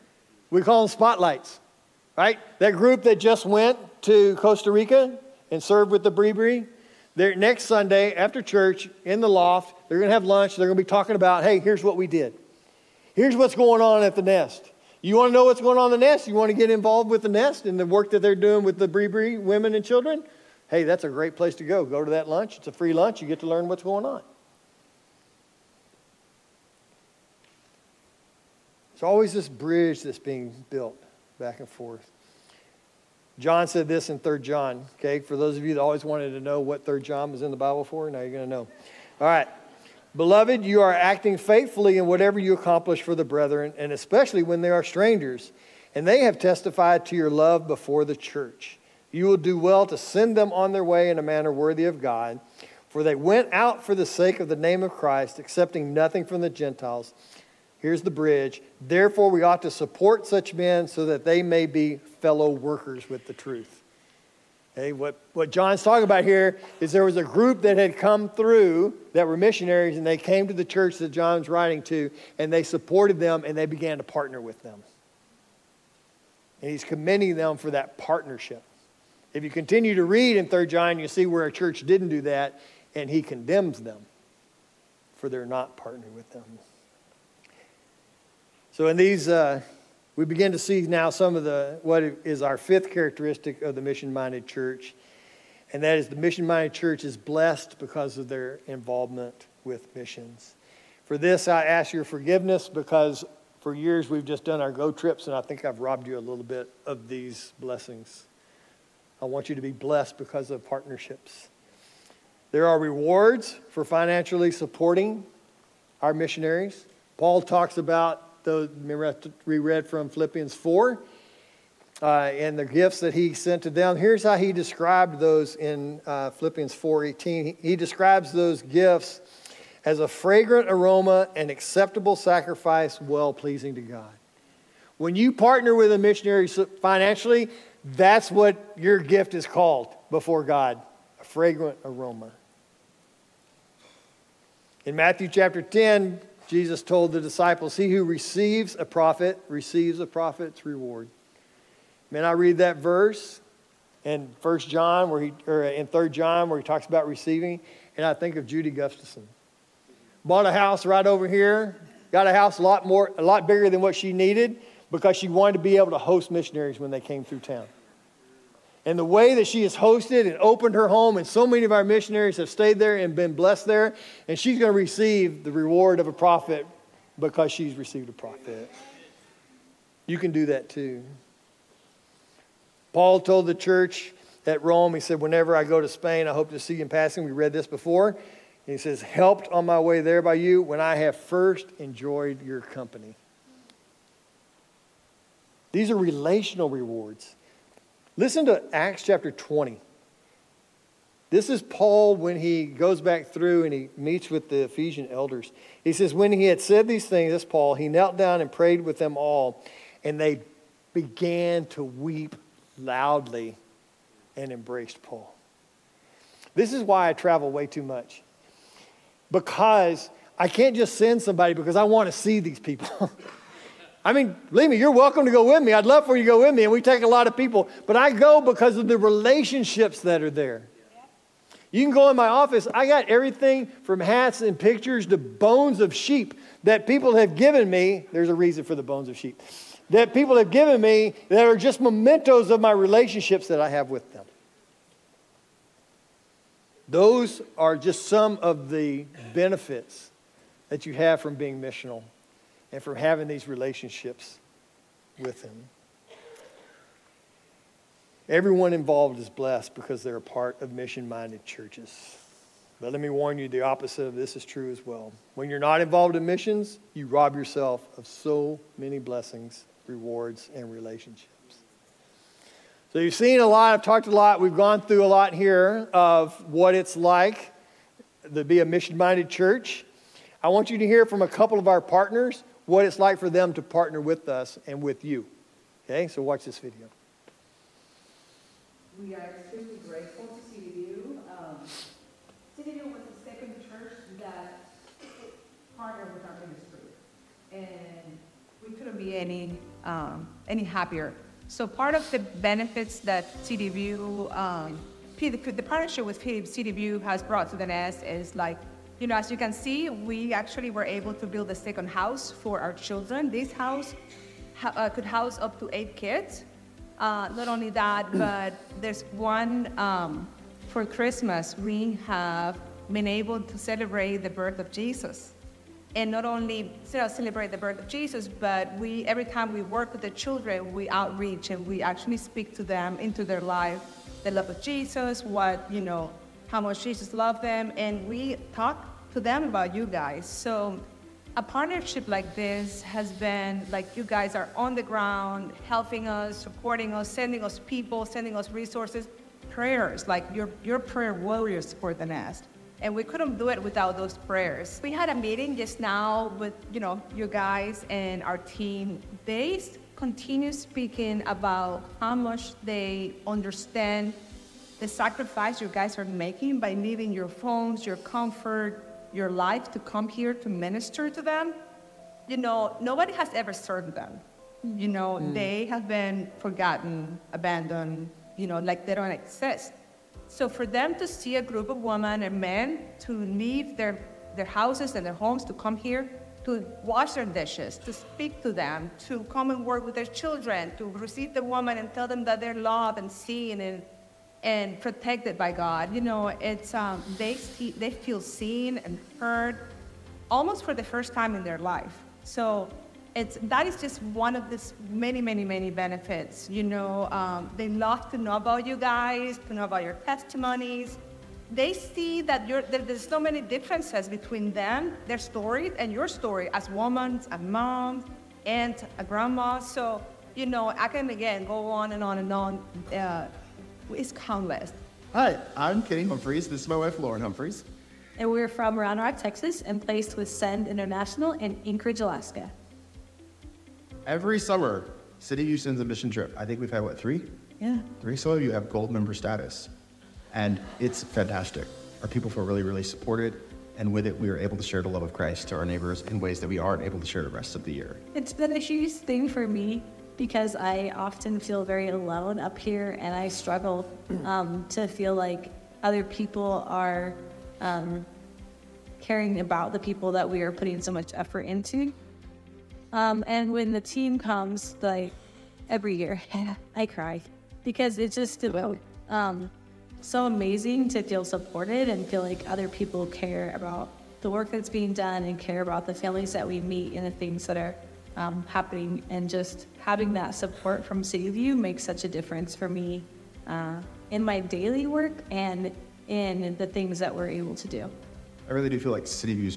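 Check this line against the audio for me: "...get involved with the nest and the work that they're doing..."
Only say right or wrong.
right.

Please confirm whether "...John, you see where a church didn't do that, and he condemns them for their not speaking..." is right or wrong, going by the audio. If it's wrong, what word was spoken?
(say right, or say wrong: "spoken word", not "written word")
wrong: "partnering", not "speaking".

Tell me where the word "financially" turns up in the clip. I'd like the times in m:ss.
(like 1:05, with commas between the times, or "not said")
1:53, 2:16.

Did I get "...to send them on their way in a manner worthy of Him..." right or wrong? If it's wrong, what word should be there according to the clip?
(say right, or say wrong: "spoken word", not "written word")
wrong: "God", not "Him".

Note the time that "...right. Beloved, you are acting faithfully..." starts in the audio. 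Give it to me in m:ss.
0:39.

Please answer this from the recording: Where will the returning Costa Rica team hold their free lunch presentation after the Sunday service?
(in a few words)
the loft.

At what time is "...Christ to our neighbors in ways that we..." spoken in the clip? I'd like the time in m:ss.
7:25.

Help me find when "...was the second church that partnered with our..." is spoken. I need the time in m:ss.
4:52.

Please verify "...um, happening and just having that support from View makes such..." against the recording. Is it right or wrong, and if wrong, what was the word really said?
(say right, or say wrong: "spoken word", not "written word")
wrong: "CityView", not "View".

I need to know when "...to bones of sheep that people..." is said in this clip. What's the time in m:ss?
3:55.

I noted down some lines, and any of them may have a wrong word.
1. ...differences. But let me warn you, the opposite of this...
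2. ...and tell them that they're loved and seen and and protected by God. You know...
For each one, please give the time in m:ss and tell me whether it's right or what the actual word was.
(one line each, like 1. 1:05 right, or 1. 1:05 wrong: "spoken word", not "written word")
1. 4:21 wrong: "churches", not "differences"
2. 6:31 right.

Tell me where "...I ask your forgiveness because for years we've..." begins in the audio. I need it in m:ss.
1:41.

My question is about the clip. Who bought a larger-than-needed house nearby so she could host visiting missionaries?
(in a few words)
Judy Gustafson.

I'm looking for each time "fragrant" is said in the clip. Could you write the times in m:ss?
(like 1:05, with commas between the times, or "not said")
2:10, 2:21.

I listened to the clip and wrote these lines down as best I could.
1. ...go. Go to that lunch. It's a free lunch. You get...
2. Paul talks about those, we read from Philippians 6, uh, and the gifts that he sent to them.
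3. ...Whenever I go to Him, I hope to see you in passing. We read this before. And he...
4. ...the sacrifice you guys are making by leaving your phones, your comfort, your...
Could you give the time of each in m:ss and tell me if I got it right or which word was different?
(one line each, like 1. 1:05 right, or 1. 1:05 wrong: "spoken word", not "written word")
1. 0:21 right
2. 1:57 wrong: "4", not "6"
3. 3:05 wrong: "Spain", not "Him"
4. 6:04 right.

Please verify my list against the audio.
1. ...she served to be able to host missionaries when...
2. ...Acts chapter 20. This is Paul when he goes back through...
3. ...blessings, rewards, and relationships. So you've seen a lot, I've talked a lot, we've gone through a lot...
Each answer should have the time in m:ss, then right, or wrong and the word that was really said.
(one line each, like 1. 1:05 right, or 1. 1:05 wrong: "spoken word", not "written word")
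1. 2:45 wrong: "wanted", not "served"
2. 3:18 right
3. 4:28 right.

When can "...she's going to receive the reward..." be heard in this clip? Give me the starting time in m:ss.
2:54.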